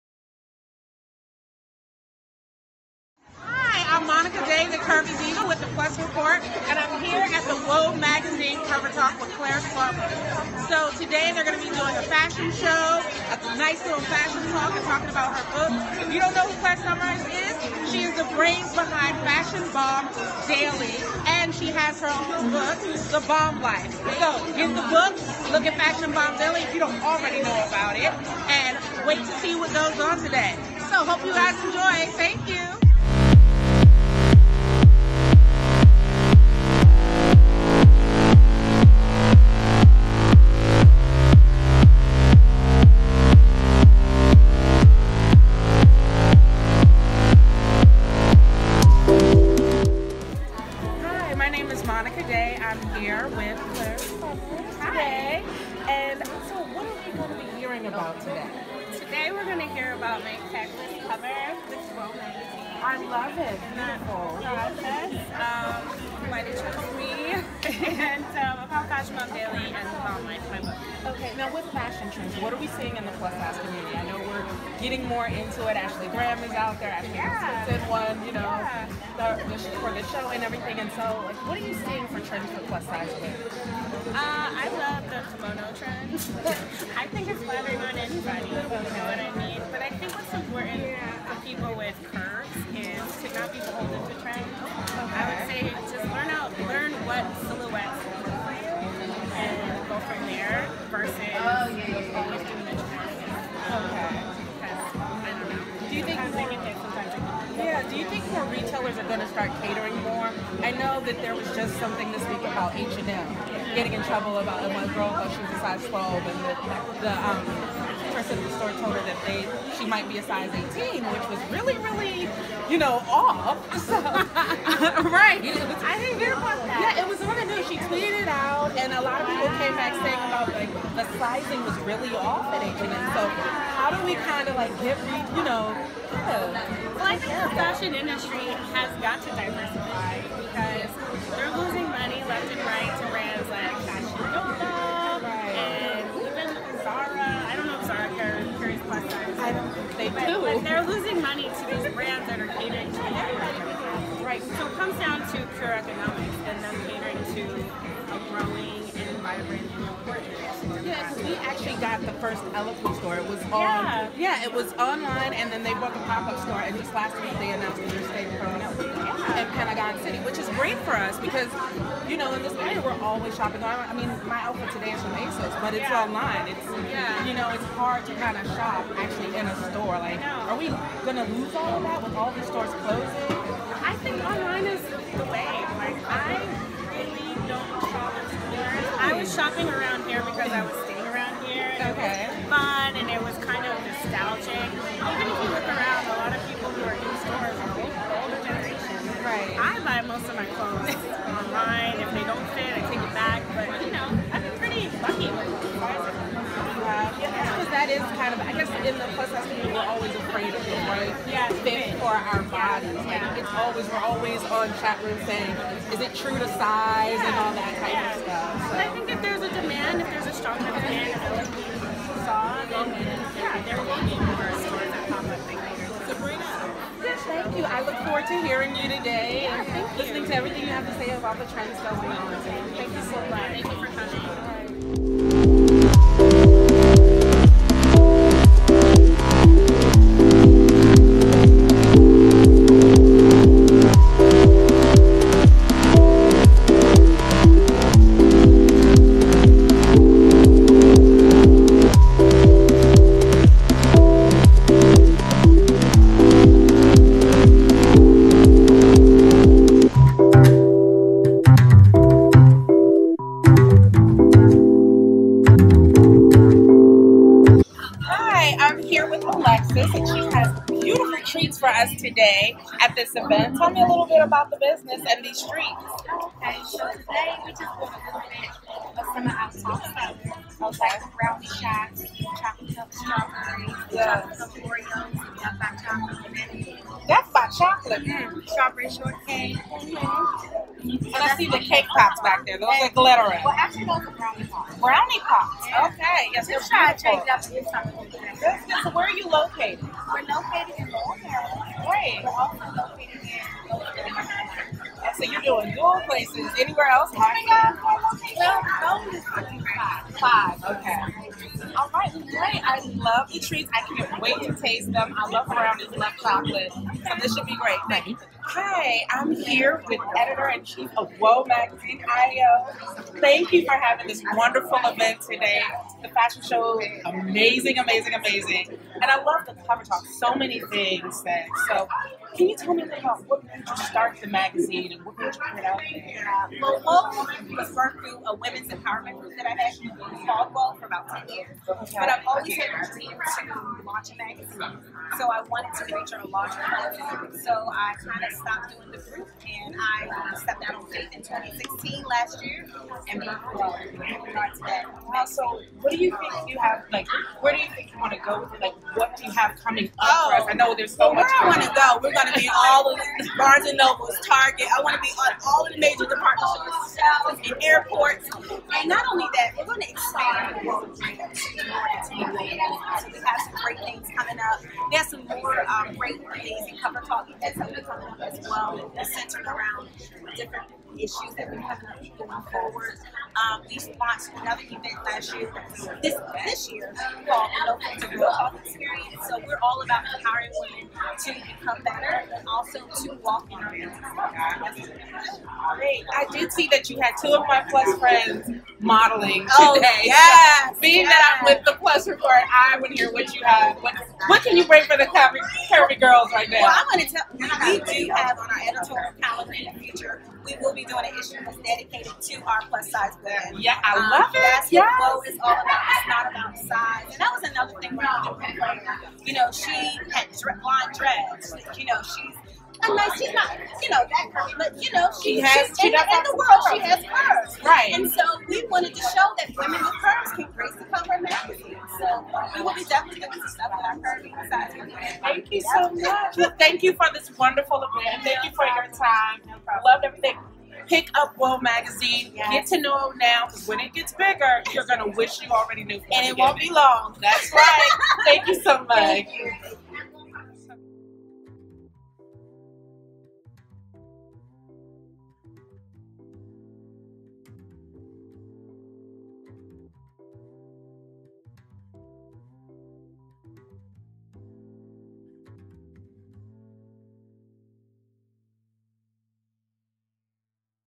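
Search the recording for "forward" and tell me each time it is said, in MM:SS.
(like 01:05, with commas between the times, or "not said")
03:48, 06:22.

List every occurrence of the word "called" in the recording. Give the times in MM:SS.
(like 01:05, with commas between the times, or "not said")
05:40, 06:27.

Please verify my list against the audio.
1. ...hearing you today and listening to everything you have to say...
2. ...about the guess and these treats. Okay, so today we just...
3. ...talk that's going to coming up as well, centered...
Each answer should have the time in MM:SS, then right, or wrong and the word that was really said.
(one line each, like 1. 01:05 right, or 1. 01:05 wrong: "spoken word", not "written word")
1. 03:48 right
2. 04:34 wrong: "business", not "guess"
3. 06:17 right.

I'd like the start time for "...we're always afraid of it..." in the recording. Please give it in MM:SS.
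03:29.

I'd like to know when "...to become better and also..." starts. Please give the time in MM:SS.
06:31.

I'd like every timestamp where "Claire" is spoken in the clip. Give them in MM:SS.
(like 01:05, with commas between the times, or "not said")
00:09, 00:16.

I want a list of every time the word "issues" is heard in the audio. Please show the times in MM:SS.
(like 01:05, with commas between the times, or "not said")
06:20, 06:51.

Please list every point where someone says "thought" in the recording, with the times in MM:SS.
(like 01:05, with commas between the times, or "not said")
01:55.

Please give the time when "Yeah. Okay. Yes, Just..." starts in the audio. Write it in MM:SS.
04:55.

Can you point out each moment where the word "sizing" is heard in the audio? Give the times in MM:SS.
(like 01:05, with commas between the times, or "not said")
02:11.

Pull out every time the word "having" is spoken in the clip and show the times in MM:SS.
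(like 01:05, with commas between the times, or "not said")
05:23, 06:21.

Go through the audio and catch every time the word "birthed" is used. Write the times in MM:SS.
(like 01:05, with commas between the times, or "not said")
05:37, 05:53.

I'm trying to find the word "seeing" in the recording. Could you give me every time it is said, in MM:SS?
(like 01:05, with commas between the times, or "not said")
01:12, 01:21.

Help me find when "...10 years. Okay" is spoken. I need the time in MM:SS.
05:41.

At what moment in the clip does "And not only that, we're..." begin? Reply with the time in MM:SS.
06:08.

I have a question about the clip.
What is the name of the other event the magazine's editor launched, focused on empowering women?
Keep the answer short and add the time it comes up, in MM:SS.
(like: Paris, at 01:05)
No Filter Real Talk Experience, at 06:27.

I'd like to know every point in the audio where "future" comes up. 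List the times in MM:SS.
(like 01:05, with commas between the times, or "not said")
06:49.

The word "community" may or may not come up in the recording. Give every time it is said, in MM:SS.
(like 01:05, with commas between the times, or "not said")
01:13, 03:29.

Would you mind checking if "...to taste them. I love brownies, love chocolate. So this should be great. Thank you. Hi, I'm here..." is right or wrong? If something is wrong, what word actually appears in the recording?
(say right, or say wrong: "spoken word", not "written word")
right.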